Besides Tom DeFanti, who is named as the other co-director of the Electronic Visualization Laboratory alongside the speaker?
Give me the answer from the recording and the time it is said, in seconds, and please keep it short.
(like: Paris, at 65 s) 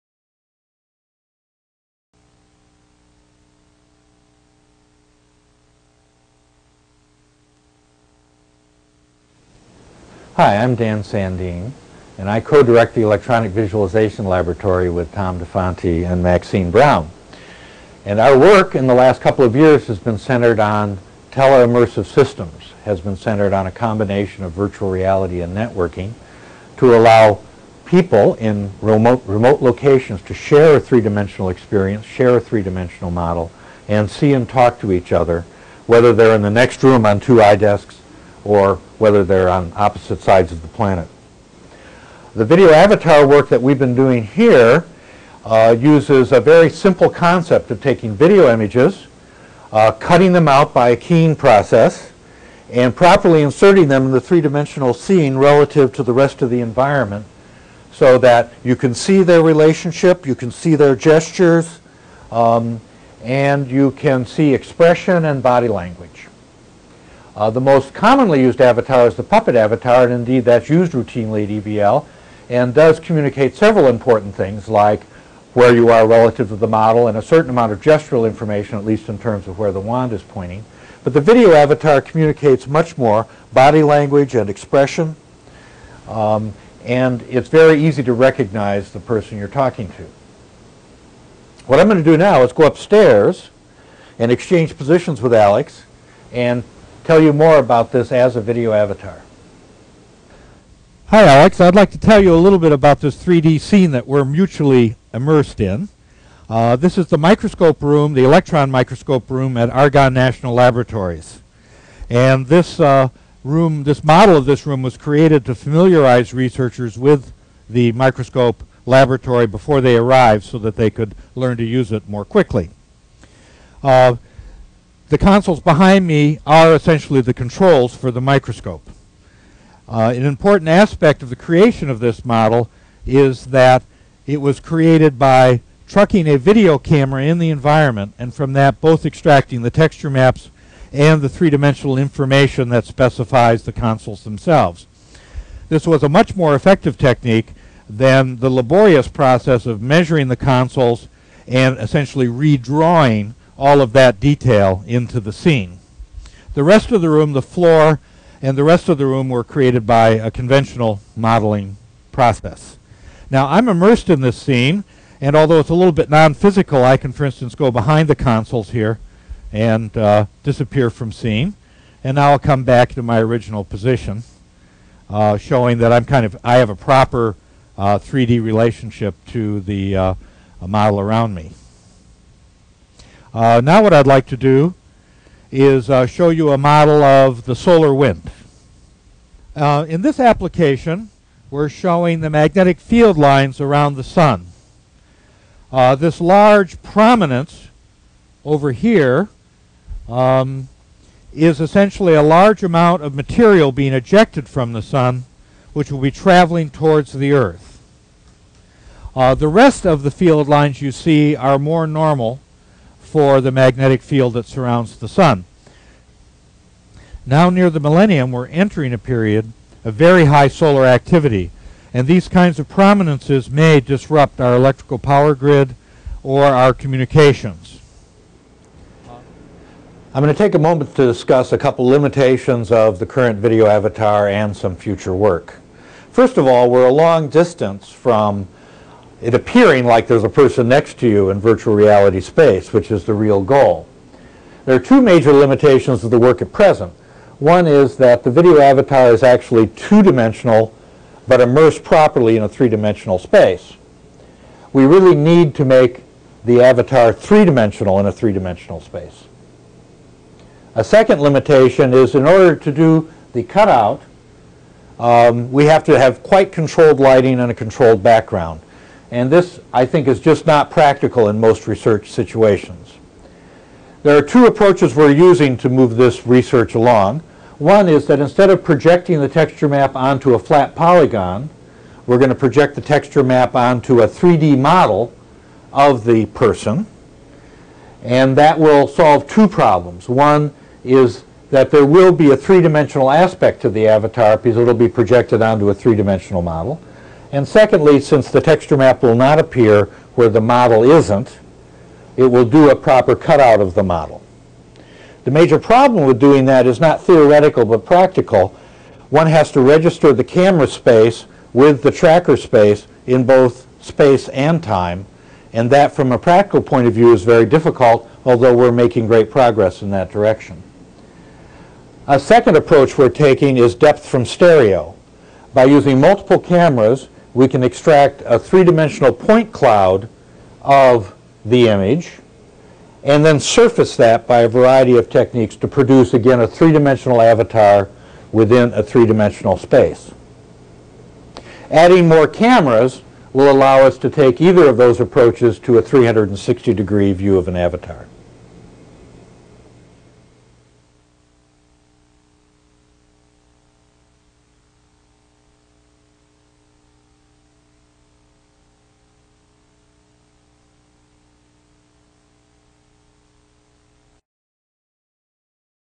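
Maxine Brown, at 16 s.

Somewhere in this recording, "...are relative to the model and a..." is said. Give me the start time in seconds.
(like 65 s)
75 s.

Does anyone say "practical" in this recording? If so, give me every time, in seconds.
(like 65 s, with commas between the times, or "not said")
270 s, 307 s, 316 s.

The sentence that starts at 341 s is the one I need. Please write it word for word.
Adding more cameras will allow us to take either of those approaches to a 360-degree view of an avatar.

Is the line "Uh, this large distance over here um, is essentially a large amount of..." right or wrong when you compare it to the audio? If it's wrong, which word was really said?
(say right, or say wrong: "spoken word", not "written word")
wrong: "prominence", not "distance".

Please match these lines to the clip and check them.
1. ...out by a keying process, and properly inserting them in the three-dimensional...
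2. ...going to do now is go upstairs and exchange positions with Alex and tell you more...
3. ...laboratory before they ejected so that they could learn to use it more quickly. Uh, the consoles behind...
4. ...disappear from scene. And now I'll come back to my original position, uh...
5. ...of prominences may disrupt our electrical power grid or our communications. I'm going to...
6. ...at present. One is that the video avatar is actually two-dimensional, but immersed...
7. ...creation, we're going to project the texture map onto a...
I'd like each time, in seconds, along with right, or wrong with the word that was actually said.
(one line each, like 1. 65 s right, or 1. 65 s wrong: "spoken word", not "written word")
1. 50 s right
2. 91 s right
3. 118 s wrong: "arrived", not "ejected"
4. 170 s right
5. 222 s right
6. 246 s right
7. 280 s wrong: "polygon", not "creation".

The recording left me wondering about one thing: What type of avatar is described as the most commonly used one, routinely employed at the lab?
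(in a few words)
Puppet avatar.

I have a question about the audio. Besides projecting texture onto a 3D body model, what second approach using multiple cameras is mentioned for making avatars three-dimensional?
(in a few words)
Depth from stereo.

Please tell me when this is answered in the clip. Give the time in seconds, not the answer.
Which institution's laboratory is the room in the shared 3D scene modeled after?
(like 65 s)
109 s.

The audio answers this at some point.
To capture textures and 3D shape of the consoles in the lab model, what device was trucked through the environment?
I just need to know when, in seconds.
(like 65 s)
136 s.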